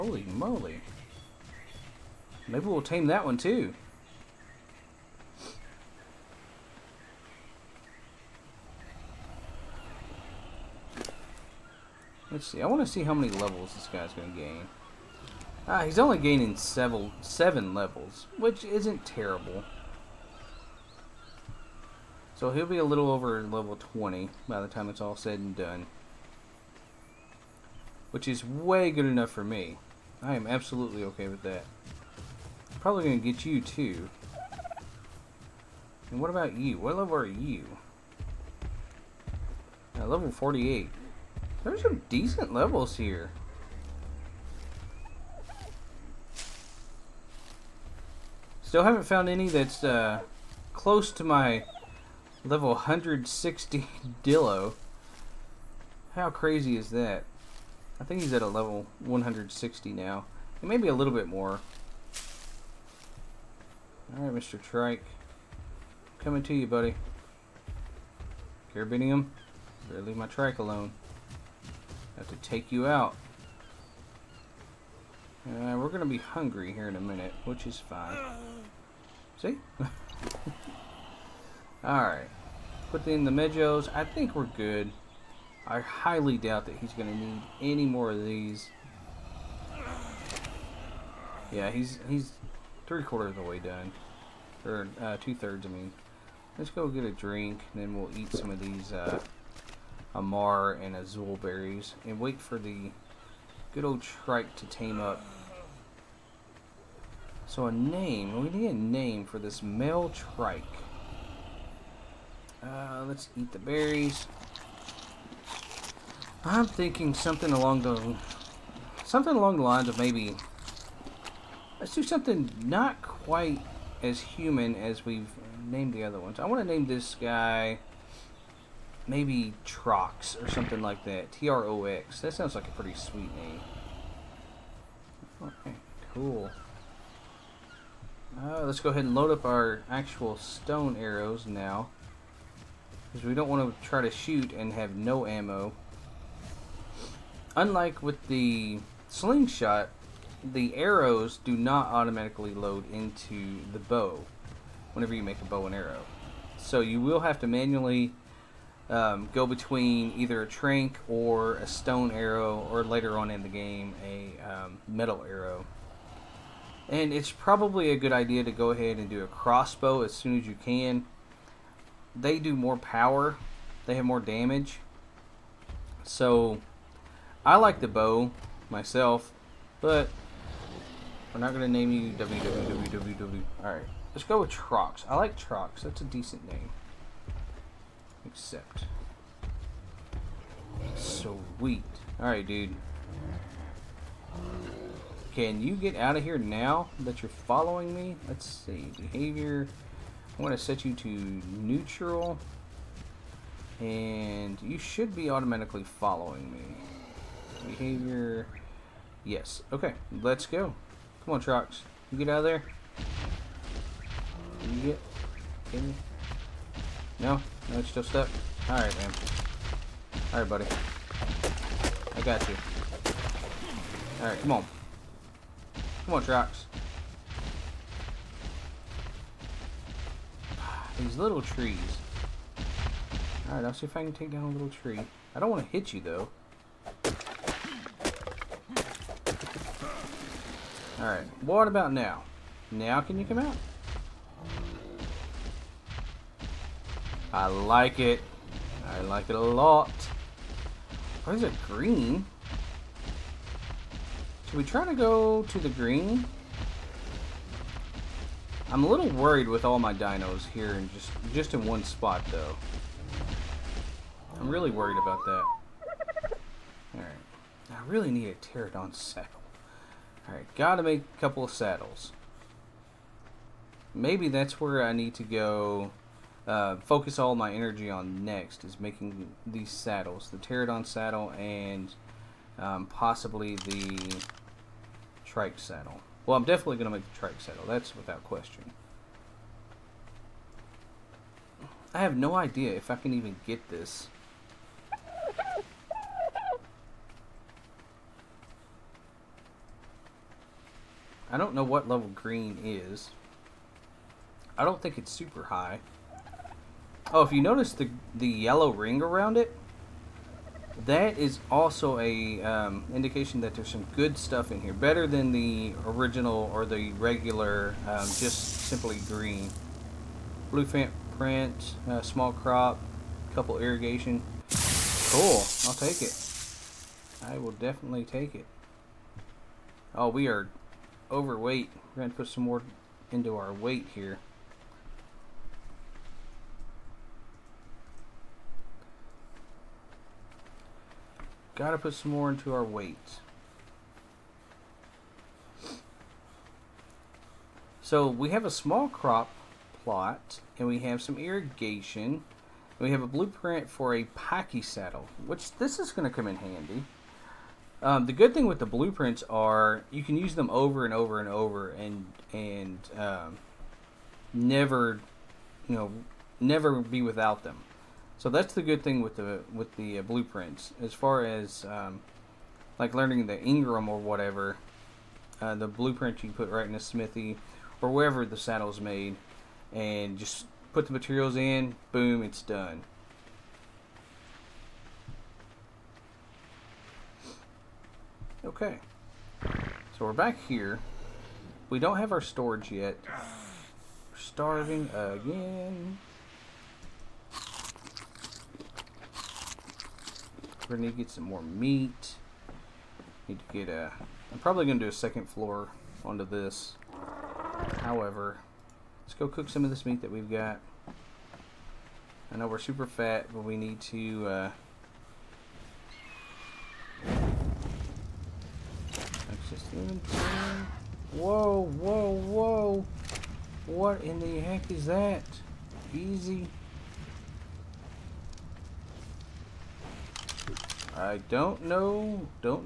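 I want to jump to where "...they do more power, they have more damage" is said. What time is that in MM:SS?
02:52.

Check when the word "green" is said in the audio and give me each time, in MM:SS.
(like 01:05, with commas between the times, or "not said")
04:11, 04:15, 05:02, 05:19.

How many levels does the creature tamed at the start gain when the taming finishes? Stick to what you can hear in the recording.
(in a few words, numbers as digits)
7.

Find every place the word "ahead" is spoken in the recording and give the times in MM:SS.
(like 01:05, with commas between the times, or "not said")
02:18, 02:48.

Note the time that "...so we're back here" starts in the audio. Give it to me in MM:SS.
06:29.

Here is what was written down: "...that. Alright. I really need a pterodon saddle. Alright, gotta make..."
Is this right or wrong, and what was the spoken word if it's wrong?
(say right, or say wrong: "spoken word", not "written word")
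right.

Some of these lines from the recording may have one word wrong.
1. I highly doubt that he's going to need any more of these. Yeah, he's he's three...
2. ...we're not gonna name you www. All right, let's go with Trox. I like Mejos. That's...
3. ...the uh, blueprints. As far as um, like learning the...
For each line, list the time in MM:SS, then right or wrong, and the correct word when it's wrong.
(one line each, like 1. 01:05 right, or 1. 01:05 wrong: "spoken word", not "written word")
1. 01:25 right
2. 03:01 wrong: "Trox", not "Mejos"
3. 06:09 right.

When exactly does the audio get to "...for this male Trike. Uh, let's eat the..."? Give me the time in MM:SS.
01:49.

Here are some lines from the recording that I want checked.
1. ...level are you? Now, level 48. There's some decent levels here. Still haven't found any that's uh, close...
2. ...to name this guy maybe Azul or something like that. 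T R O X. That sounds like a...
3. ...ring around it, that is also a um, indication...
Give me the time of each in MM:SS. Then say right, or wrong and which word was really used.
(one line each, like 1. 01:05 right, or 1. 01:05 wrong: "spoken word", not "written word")
1. 00:36 right
2. 02:06 wrong: "Trox", not "Azul"
3. 05:08 right.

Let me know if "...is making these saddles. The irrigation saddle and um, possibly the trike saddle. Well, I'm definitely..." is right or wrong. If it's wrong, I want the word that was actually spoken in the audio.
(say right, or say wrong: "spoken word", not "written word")
wrong: "pterodon", not "irrigation".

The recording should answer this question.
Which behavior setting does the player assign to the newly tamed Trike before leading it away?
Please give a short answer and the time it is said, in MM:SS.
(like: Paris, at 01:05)
neutral, at 03:21.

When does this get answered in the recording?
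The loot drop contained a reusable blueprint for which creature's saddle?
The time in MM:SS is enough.
05:54.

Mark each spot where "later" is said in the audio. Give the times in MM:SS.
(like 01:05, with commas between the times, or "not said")
02:42.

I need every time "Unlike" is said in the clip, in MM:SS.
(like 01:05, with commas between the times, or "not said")
02:27.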